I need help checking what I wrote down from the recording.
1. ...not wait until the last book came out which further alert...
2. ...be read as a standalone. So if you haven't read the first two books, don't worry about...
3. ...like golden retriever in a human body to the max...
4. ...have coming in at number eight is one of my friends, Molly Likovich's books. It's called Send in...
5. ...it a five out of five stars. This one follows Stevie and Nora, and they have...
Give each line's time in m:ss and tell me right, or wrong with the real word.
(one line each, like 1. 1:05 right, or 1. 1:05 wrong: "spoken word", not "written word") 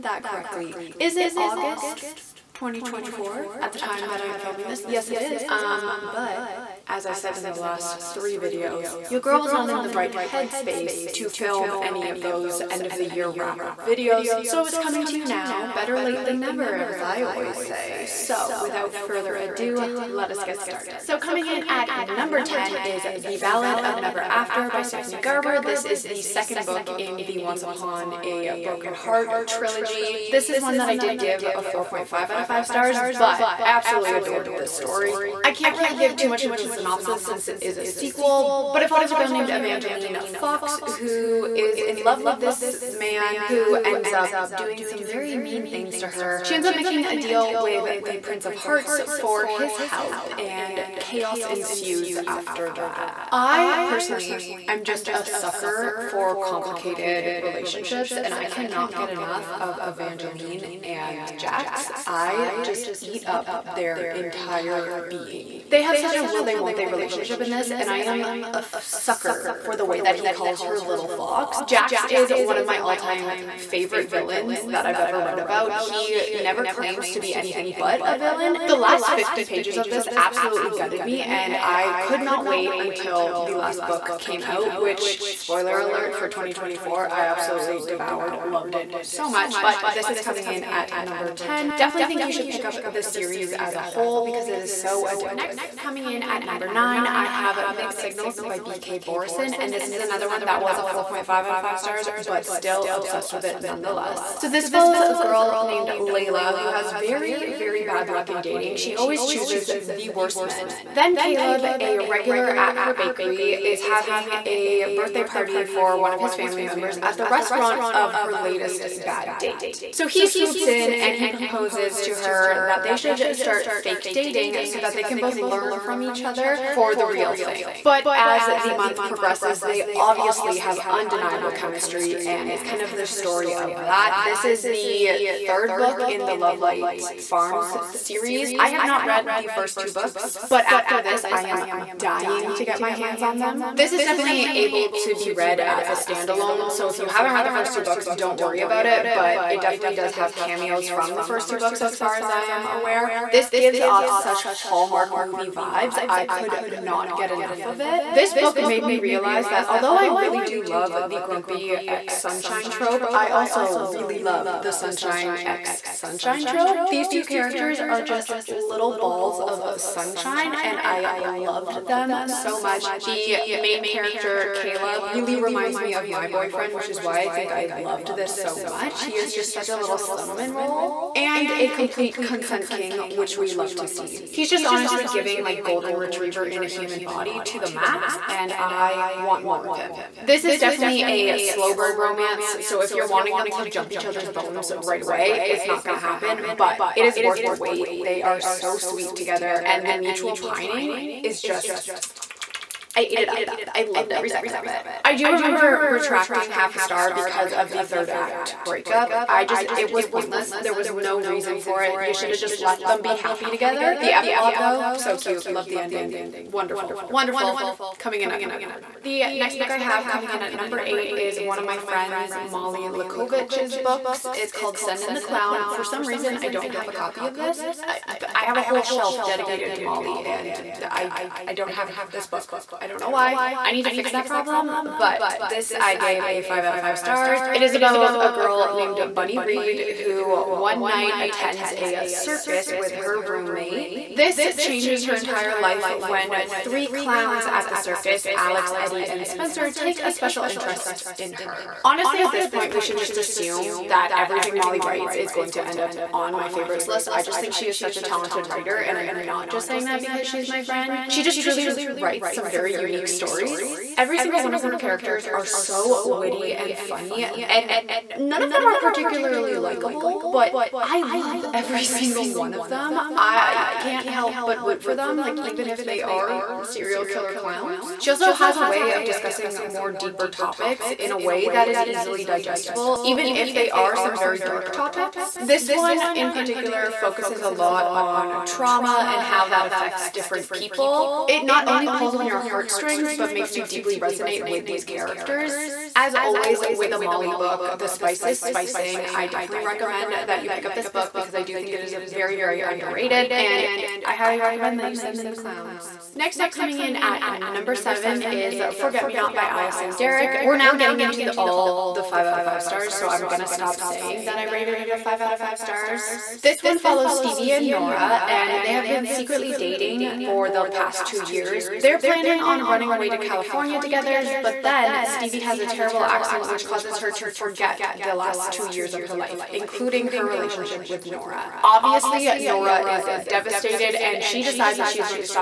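1. 1:22 wrong: "spoiler", not "further"
2. 2:25 right
3. 3:05 right
4. 3:39 right
5. 5:14 right.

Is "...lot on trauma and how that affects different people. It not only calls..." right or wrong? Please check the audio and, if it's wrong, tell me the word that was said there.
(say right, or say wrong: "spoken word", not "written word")
wrong: "pulls", not "calls".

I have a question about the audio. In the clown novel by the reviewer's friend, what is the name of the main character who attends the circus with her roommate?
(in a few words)
Bunny Reed.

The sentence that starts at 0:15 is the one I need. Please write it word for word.
Better late than never, as I always say.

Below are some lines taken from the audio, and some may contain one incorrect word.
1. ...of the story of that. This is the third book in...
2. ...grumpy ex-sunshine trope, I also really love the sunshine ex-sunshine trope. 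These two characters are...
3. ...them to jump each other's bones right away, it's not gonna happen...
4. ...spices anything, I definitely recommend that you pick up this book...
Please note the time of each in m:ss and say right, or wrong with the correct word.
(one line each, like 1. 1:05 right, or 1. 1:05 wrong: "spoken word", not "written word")
1. 2:12 right
2. 2:41 right
3. 3:13 right
4. 4:57 wrong: "spicing", not "anything".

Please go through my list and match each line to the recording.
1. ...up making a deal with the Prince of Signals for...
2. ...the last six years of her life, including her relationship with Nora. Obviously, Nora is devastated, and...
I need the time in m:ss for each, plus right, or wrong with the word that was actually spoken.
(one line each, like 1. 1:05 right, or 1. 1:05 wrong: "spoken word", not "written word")
1. 0:46 wrong: "Hearts", not "Signals"
2. 5:27 wrong: "two", not "six".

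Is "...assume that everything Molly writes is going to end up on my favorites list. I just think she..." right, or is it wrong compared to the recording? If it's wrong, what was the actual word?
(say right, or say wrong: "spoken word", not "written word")
right.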